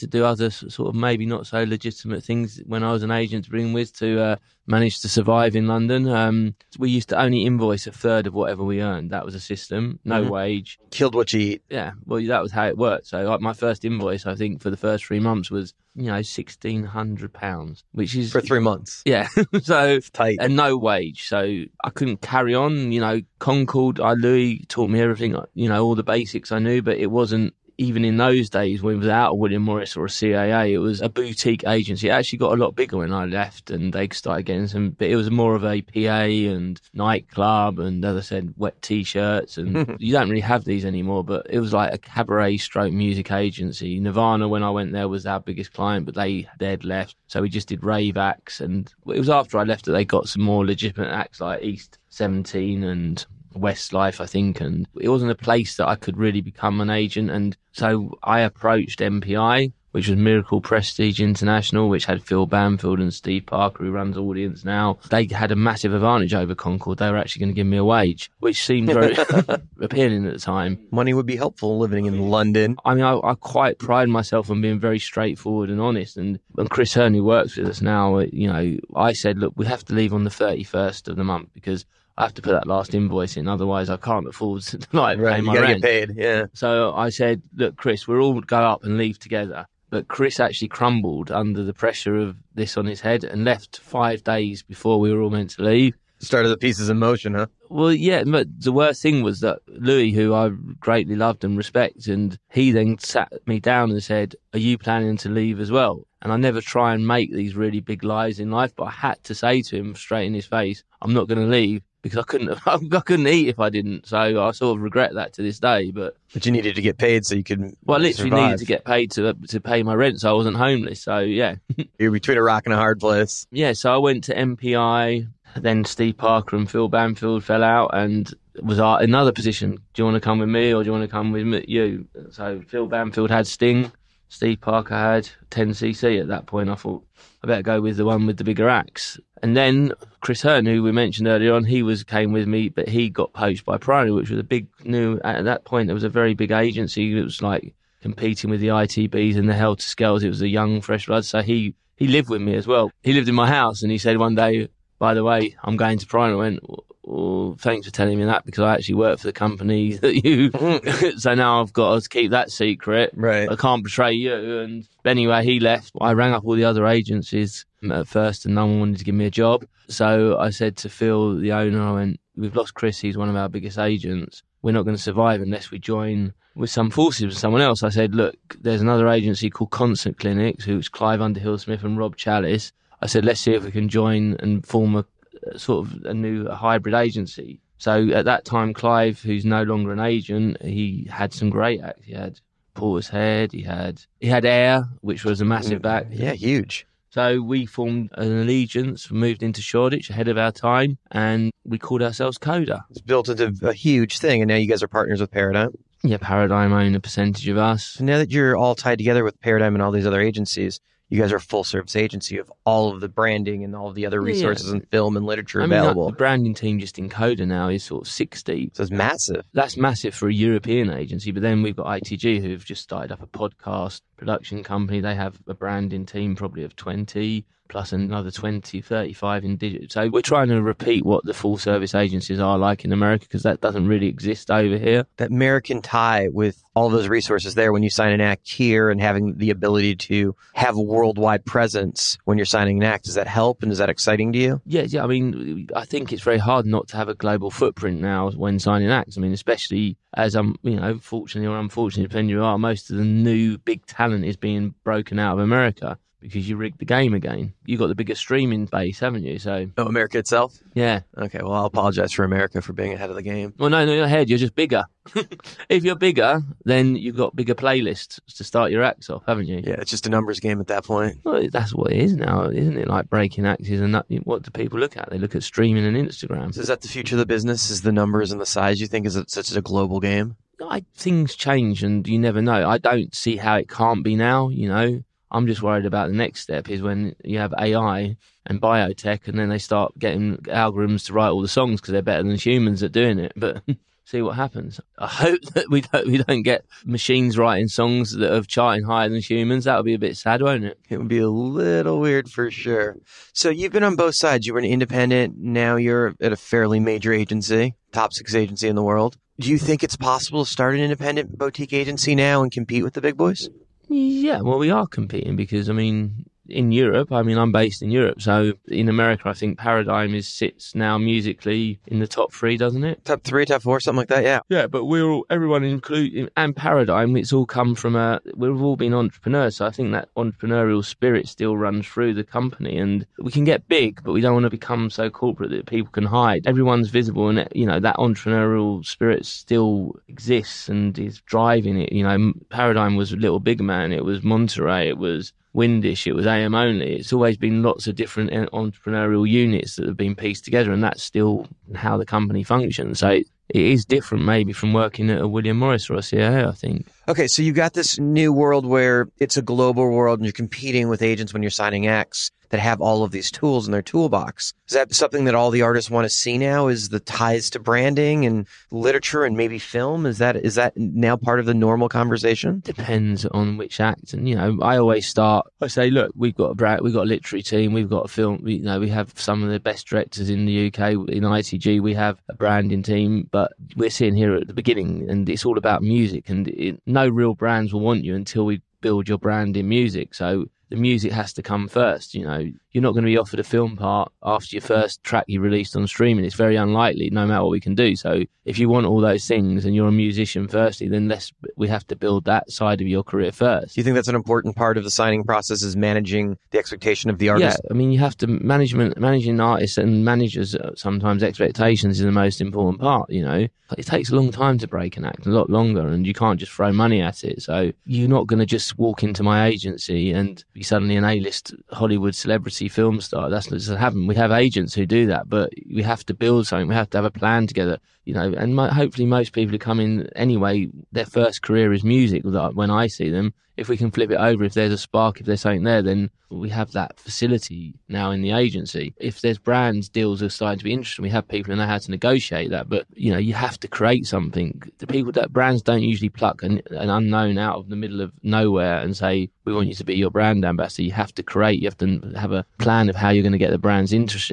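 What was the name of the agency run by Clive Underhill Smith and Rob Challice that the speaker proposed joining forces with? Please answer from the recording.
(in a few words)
Constant Clinics.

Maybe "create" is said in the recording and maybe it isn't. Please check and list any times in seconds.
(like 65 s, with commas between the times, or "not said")
443 s, 451 s.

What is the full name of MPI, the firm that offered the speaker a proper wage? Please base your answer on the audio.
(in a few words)
Miracle Prestige International.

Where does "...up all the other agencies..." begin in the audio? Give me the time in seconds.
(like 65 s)
166 s.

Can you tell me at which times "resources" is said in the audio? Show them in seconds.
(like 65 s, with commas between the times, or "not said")
214 s, 237 s.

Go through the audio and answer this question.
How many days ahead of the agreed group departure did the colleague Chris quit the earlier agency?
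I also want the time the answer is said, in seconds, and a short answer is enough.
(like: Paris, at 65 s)
Five days, at 93 s.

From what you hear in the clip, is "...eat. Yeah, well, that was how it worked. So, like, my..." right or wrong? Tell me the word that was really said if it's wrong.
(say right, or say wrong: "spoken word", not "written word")
right.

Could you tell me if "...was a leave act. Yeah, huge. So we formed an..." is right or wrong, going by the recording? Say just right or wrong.
wrong.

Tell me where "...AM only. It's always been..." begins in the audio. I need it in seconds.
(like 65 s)
346 s.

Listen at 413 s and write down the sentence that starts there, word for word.
You know, it takes a long time to break an act, a lot longer, and you can't just throw money at it.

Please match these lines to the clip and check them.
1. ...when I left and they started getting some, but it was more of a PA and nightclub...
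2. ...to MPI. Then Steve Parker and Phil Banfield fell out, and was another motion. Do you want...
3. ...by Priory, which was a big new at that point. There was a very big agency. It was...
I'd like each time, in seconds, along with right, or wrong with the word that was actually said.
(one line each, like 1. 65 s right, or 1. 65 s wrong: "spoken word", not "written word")
1. 32 s right
2. 124 s wrong: "position", not "motion"
3. 143 s right.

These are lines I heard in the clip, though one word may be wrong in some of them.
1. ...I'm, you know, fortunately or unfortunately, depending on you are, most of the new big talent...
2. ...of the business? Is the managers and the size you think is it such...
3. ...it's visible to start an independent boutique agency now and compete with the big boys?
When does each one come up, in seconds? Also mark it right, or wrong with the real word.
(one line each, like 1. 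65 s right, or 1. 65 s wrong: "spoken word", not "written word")
1. 250 s right
2. 277 s wrong: "numbers", not "managers"
3. 309 s wrong: "possible", not "visible".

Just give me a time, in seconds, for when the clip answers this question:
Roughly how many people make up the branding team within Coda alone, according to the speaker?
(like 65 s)
218 s.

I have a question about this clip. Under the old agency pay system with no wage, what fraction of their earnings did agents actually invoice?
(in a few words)
A third.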